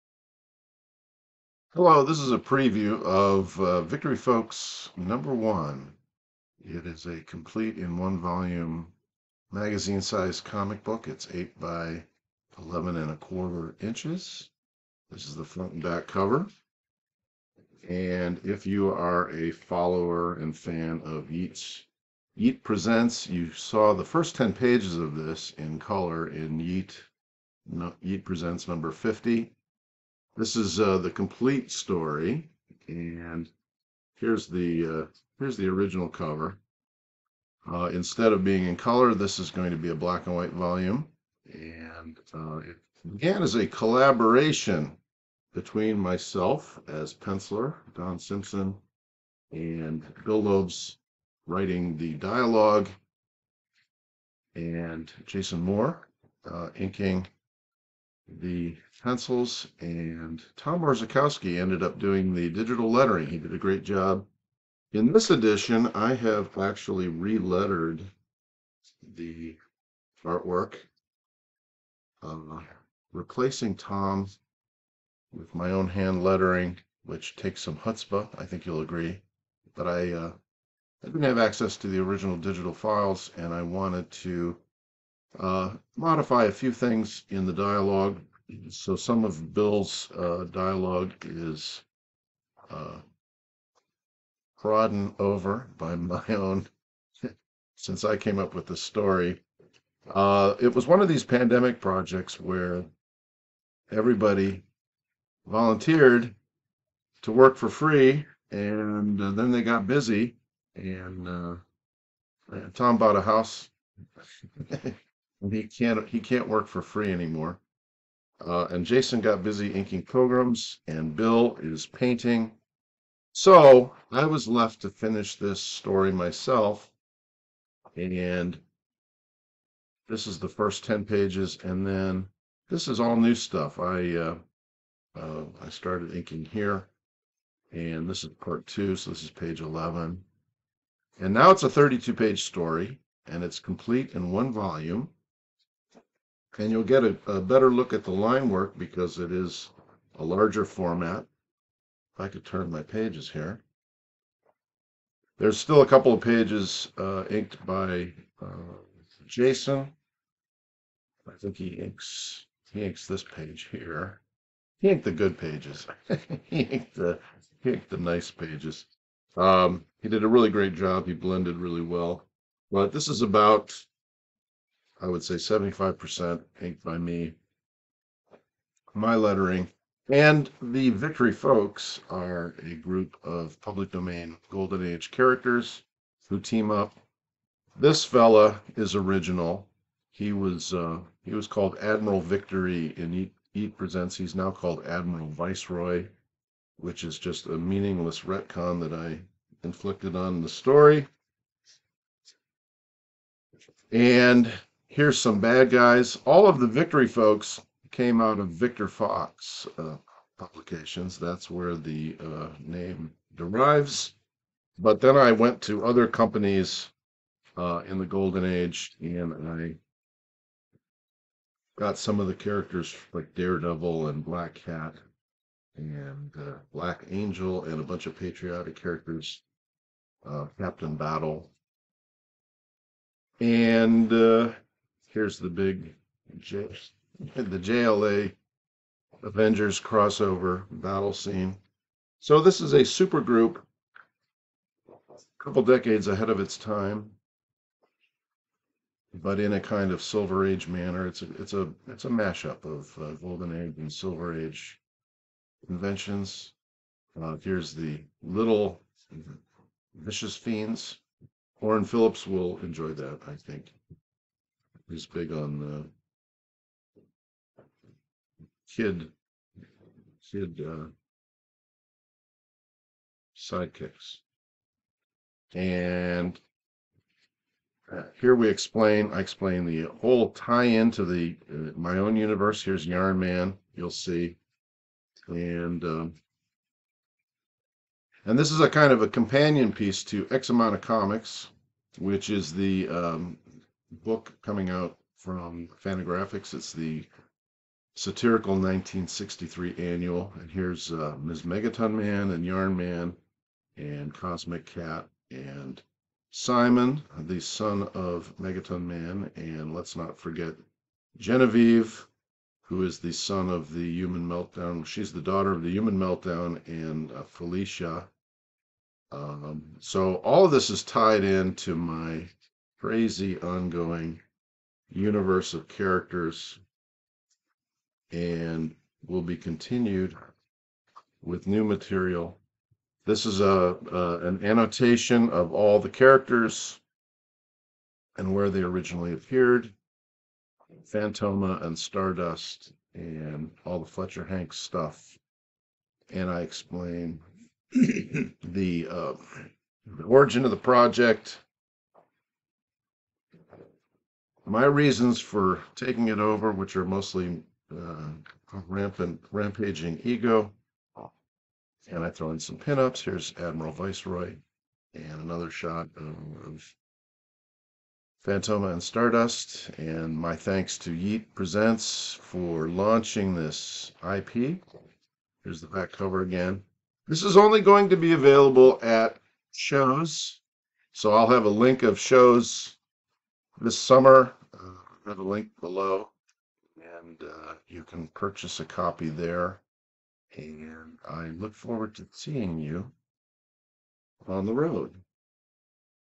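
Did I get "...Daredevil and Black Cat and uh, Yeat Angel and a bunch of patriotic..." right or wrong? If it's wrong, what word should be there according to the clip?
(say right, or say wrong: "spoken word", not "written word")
wrong: "Black", not "Yeat".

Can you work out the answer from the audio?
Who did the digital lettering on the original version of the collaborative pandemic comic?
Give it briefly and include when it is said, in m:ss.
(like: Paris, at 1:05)
Tom Orzechowski, at 1:00.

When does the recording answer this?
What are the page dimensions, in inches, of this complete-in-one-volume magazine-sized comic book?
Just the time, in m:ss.
0:11.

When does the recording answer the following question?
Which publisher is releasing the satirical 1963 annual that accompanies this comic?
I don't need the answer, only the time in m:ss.
4:55.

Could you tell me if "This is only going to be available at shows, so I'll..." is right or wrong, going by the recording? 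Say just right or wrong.
right.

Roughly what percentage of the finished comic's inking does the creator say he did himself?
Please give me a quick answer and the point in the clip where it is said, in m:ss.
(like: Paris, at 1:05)
75%, at 2:55.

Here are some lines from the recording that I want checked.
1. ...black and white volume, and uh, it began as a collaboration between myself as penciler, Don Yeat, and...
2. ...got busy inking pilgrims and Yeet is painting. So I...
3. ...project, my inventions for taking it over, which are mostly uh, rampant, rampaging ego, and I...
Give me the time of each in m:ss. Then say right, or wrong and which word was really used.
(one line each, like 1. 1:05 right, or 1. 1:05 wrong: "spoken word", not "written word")
1. 0:39 wrong: "Simpson", not "Yeat"
2. 1:59 wrong: "Bill", not "Yeet"
3. 5:50 wrong: "reasons", not "inventions".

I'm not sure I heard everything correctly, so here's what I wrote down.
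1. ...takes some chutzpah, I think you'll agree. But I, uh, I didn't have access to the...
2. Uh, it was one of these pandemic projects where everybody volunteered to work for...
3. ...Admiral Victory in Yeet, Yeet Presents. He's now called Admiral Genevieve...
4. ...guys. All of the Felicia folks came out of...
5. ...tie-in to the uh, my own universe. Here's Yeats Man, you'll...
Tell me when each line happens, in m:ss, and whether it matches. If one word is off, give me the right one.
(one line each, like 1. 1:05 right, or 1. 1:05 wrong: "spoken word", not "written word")
1. 1:17 right
2. 1:40 right
3. 3:11 wrong: "Viceroy", not "Genevieve"
4. 3:25 wrong: "Victory", not "Felicia"
5. 4:40 wrong: "Yarn", not "Yeats".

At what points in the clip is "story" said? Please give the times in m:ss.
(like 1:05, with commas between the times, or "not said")
0:31, 1:38, 2:05, 2:22, 3:20.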